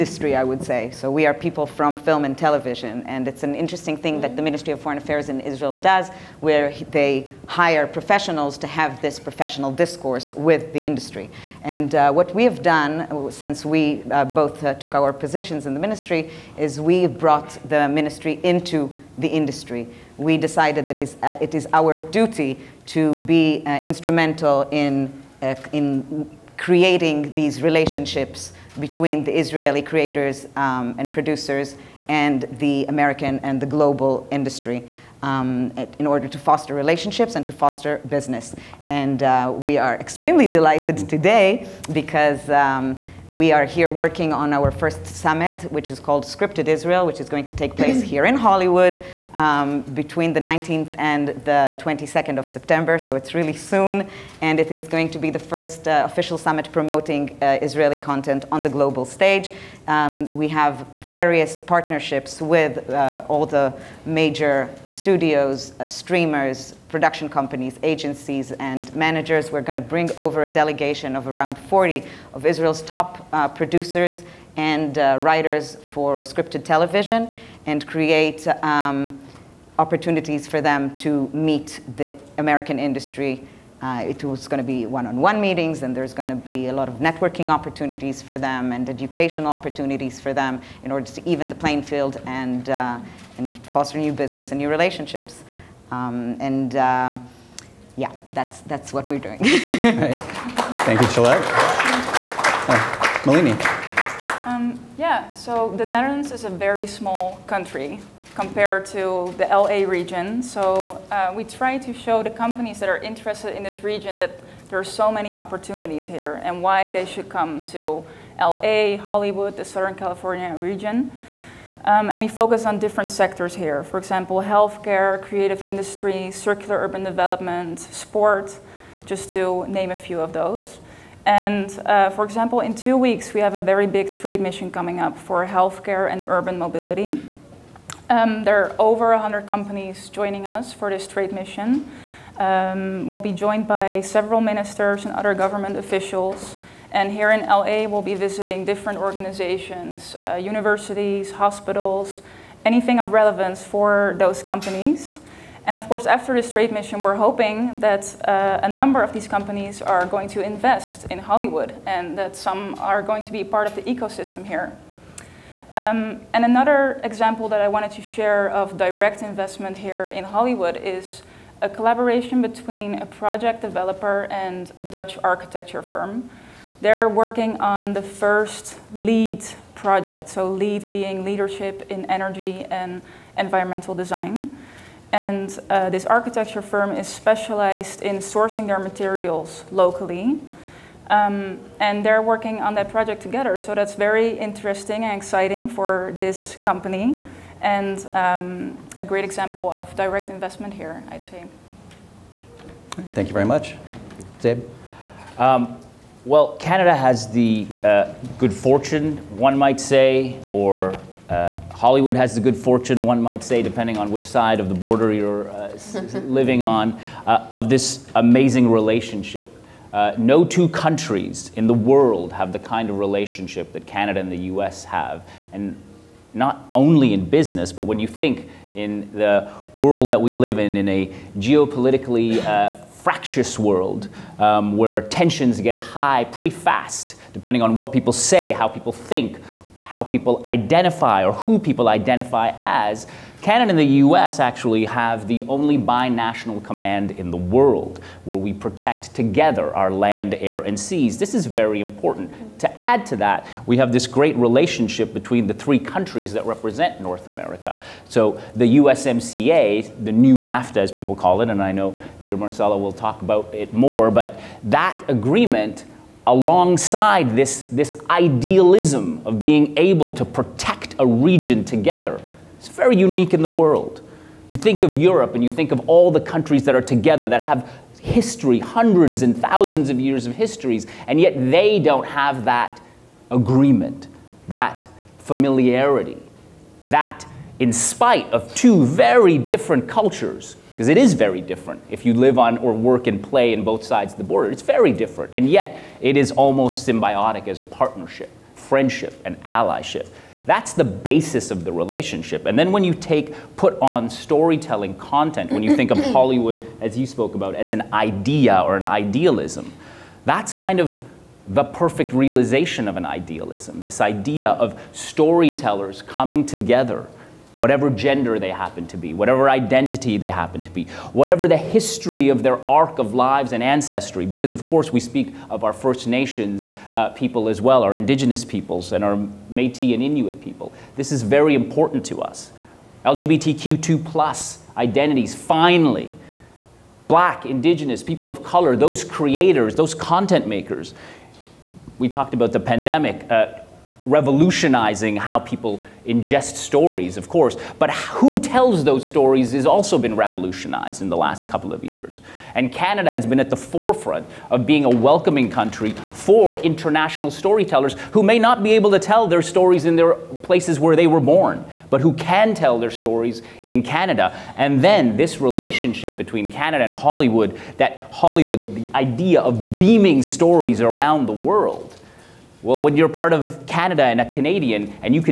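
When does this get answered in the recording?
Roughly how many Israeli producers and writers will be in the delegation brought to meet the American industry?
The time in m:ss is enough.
1:11.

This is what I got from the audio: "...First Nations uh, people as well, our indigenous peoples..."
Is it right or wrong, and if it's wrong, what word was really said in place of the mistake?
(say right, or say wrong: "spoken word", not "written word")
right.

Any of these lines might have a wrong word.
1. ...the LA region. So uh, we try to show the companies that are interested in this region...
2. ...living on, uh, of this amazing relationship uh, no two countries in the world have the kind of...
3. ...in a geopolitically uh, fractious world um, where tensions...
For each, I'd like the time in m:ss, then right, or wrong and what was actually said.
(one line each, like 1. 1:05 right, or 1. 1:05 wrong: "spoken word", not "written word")
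1. 1:49 right
2. 3:36 right
3. 3:50 right.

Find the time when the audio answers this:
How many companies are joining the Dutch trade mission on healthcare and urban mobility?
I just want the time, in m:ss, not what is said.
2:18.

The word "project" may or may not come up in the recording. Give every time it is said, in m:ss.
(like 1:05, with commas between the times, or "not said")
2:53, 2:59, 3:12.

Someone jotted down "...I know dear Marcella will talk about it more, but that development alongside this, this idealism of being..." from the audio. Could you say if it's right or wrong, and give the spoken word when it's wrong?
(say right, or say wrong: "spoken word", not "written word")
wrong: "agreement", not "development".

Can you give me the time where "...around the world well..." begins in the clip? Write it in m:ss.
6:10.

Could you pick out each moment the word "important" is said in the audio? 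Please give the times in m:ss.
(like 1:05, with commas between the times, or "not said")
4:11, 5:31.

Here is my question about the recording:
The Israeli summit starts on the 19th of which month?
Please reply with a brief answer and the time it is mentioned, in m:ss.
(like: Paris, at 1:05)
September, at 0:52.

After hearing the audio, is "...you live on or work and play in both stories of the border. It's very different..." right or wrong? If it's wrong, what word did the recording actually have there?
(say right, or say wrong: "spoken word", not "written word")
wrong: "sides", not "stories".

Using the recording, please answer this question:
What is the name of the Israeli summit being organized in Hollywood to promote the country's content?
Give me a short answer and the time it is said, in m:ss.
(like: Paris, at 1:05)
Scripted Israel, at 0:46.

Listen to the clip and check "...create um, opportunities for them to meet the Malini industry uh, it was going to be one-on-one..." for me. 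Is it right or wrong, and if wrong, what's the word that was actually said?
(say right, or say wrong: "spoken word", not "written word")
wrong: "American", not "Malini".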